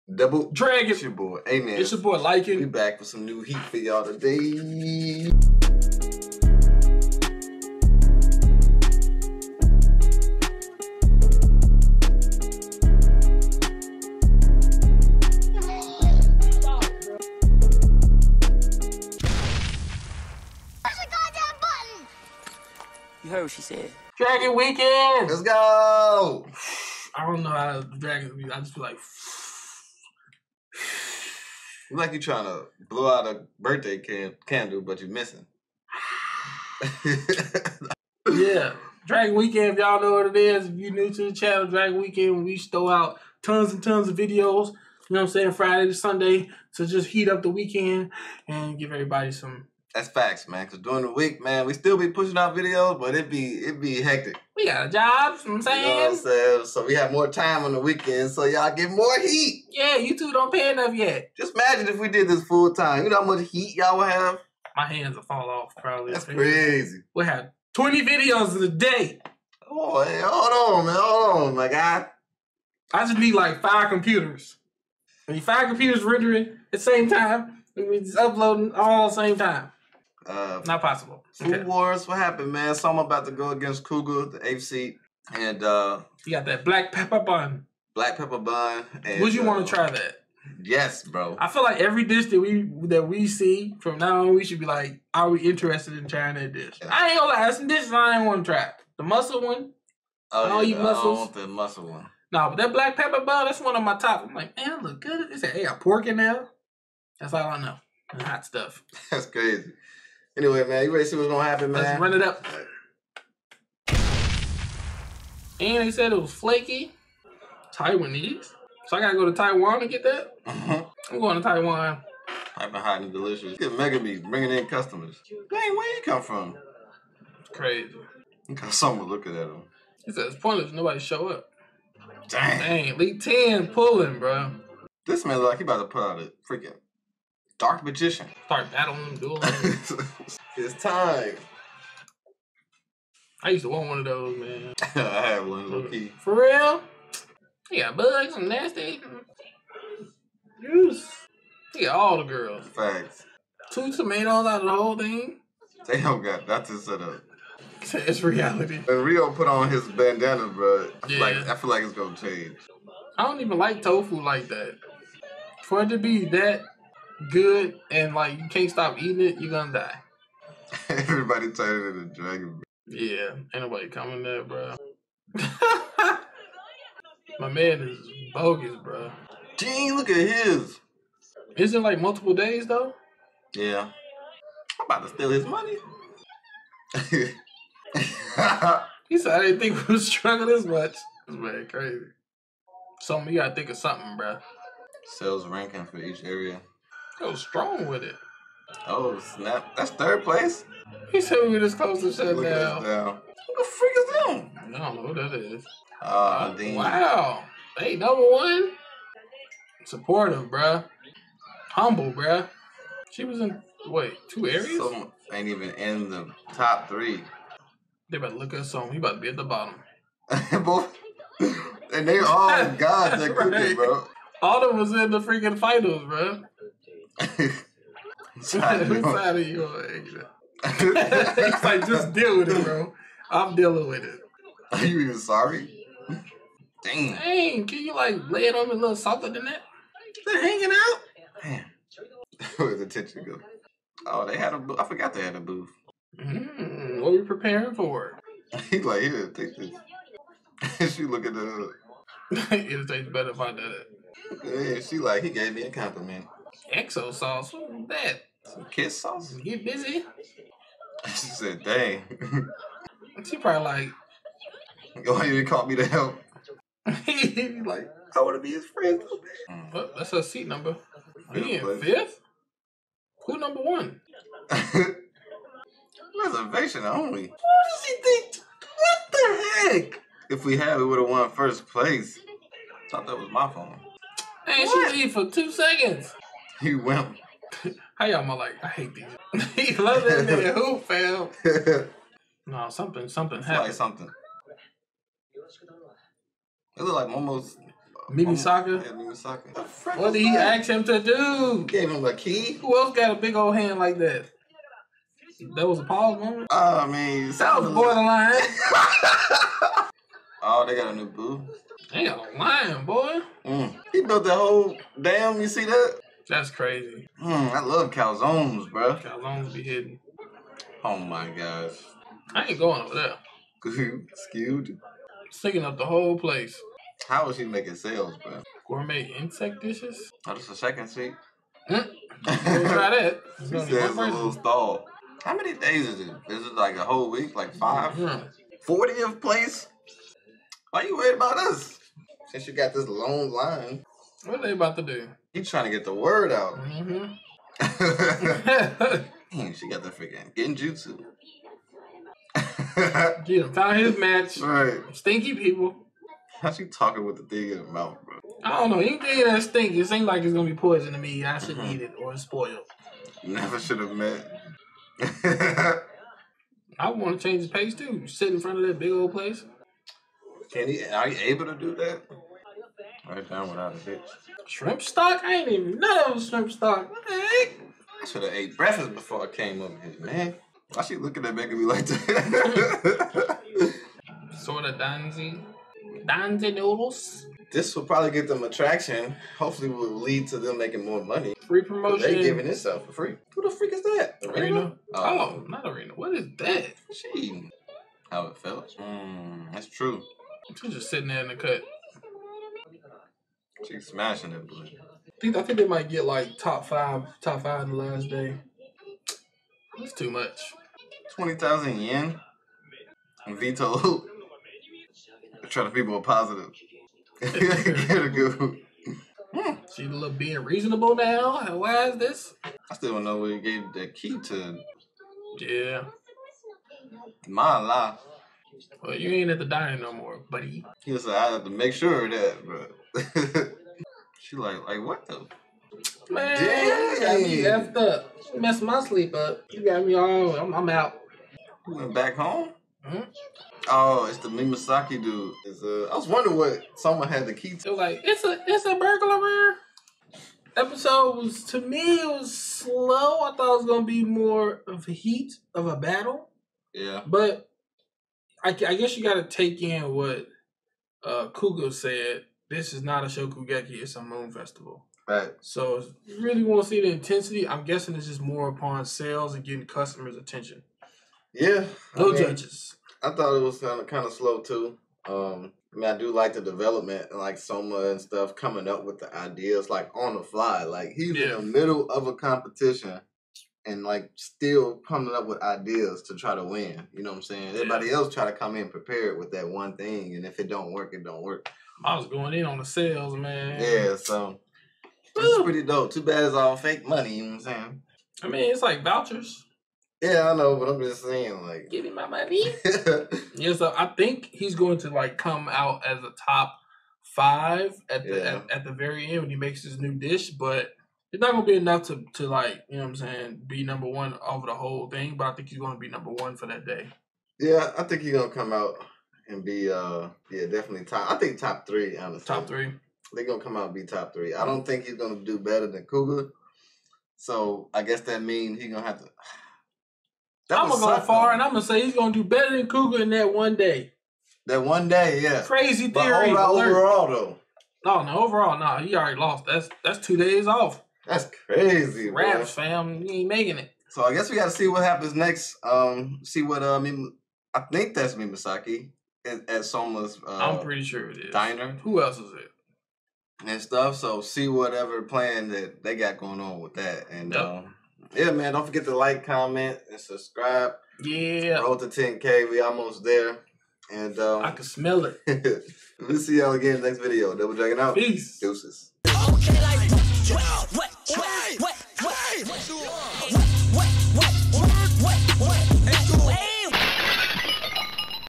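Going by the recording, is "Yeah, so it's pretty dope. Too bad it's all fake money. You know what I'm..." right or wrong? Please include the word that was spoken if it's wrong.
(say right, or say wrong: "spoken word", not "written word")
right.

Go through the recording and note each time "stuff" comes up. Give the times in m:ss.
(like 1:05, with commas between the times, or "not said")
1:48, 7:58, 9:13.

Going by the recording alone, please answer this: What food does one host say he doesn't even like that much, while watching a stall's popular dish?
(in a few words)
Tofu.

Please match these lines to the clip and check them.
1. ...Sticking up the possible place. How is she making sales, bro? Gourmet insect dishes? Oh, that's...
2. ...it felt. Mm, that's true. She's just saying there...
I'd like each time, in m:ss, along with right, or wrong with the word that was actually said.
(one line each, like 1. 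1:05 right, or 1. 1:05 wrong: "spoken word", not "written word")
1. 5:25 wrong: "whole", not "possible"
2. 6:38 wrong: "sitting", not "saying".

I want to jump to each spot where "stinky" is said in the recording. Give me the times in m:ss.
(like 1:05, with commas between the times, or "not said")
5:54, 5:59.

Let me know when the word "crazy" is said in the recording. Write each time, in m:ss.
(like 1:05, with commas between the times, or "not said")
1:06, 1:49, 2:07, 3:11, 5:16, 8:55, 9:01.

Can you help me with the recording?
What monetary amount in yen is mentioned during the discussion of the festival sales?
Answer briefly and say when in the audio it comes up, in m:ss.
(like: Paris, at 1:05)
20,000 yen, at 6:51.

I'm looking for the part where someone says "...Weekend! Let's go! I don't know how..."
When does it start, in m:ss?
0:24.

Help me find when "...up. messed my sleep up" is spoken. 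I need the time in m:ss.
7:17.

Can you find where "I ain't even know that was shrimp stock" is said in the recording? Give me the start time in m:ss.
6:15.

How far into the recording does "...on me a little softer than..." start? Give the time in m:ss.
3:58.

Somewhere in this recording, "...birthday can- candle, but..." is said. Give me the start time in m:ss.
0:33.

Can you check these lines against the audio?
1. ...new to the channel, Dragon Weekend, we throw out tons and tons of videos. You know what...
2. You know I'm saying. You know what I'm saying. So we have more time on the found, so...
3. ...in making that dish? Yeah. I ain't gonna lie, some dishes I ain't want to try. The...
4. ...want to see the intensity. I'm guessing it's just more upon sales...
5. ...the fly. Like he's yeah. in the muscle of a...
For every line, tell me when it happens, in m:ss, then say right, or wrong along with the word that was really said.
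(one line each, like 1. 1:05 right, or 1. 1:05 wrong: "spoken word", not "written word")
1. 0:40 right
2. 0:55 wrong: "weekend", not "found"
3. 1:35 wrong: "trying", not "making"
4. 7:46 right
5. 8:00 wrong: "middle", not "muscle".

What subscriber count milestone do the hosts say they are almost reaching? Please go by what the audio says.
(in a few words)
10k.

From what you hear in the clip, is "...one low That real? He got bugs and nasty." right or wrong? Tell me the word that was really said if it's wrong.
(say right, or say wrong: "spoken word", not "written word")
wrong: "For", not "That".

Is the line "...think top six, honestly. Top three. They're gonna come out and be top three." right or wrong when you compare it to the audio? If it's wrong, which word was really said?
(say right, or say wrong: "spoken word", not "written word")
wrong: "three", not "six".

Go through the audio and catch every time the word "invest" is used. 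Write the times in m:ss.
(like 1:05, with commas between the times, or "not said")
not said.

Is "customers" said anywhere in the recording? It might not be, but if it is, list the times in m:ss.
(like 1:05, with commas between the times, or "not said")
2:04, 7:49.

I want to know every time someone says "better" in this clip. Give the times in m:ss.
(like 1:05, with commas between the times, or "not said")
4:13, 8:45, 8:52.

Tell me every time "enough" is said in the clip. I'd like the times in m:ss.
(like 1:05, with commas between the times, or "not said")
1:00, 8:31.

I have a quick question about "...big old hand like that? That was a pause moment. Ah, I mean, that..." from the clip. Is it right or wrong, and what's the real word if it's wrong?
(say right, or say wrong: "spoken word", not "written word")
right.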